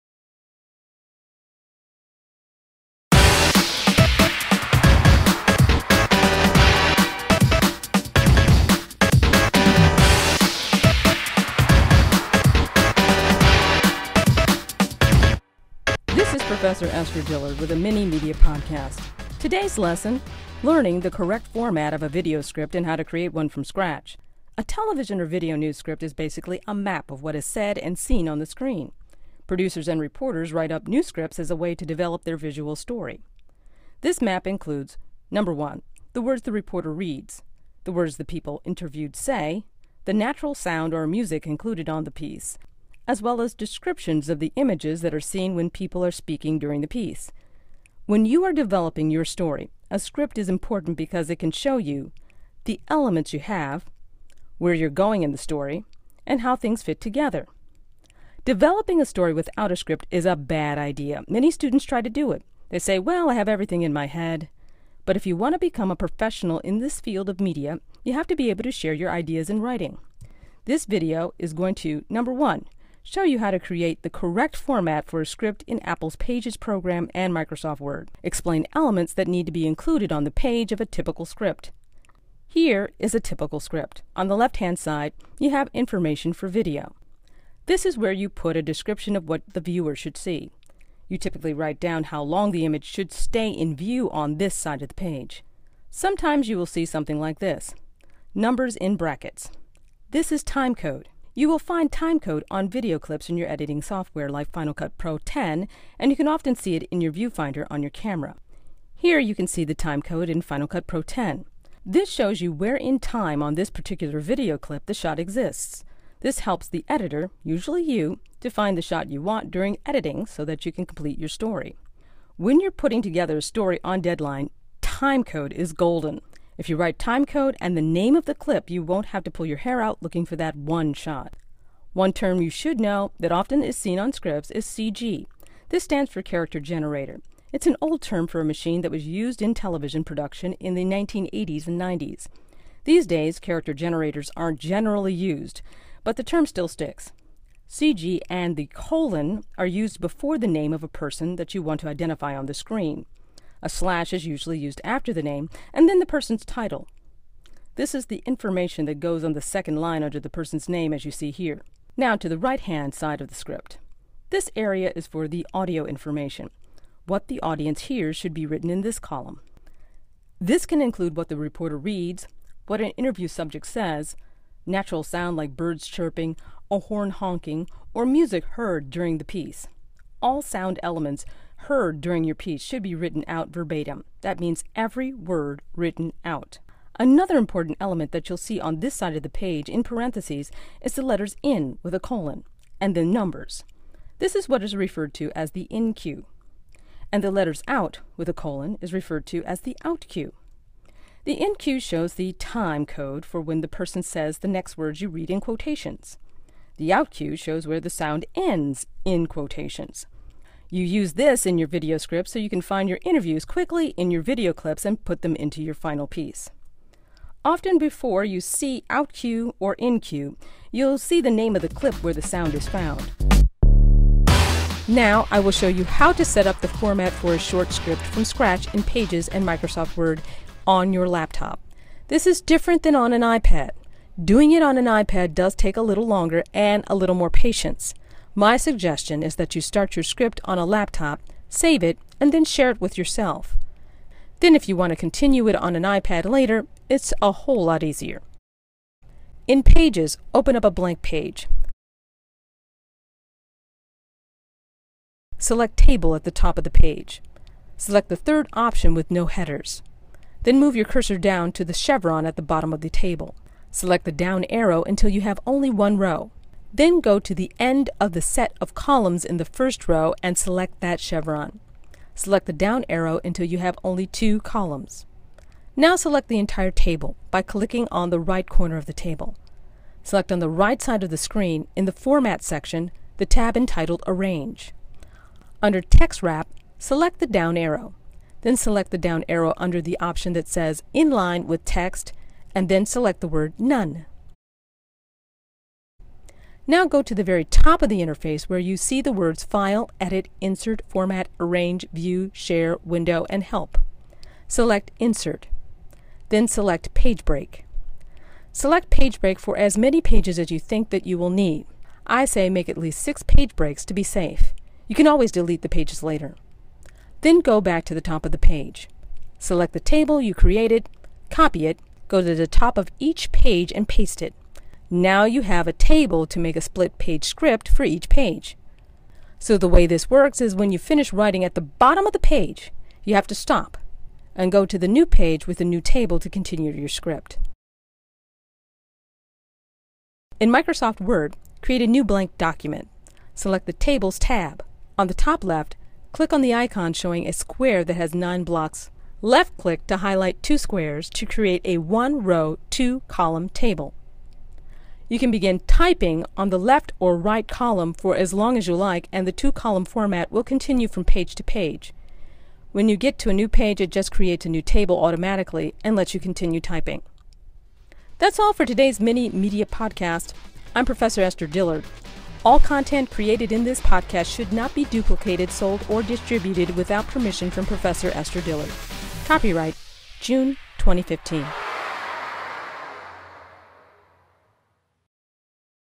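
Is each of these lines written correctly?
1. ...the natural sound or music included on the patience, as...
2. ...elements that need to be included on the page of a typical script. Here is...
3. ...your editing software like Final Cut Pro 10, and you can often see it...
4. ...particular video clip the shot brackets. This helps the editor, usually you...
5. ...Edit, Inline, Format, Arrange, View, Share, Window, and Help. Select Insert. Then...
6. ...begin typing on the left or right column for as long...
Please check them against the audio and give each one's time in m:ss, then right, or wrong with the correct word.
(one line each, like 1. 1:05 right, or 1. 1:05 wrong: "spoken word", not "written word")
1. 0:40 wrong: "piece", not "patience"
2. 1:18 right
3. 1:43 right
4. 1:53 wrong: "exists", not "brackets"
5. 4:59 wrong: "Insert", not "Inline"
6. 5:55 right.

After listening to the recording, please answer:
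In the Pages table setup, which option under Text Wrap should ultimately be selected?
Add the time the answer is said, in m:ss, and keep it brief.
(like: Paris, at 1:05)
None, at 4:53.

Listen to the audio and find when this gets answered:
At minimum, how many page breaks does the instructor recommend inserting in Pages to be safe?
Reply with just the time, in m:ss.
5:13.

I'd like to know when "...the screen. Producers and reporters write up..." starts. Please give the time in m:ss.
0:28.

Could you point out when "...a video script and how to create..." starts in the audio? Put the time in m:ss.
0:22.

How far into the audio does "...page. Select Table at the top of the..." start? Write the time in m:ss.
4:11.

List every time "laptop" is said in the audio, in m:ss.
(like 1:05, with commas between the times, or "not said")
3:51, 4:00.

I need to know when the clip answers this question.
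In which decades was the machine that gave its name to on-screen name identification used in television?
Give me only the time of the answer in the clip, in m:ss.
2:20.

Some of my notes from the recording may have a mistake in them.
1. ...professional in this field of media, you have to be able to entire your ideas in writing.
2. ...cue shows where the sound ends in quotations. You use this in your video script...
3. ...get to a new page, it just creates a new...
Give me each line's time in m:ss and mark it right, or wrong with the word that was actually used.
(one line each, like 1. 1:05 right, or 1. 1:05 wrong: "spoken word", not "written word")
1. 1:05 wrong: "share", not "entire"
2. 3:27 right
3. 6:02 right.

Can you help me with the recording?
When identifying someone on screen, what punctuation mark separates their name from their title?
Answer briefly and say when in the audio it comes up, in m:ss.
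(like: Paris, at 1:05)
slash, at 2:33.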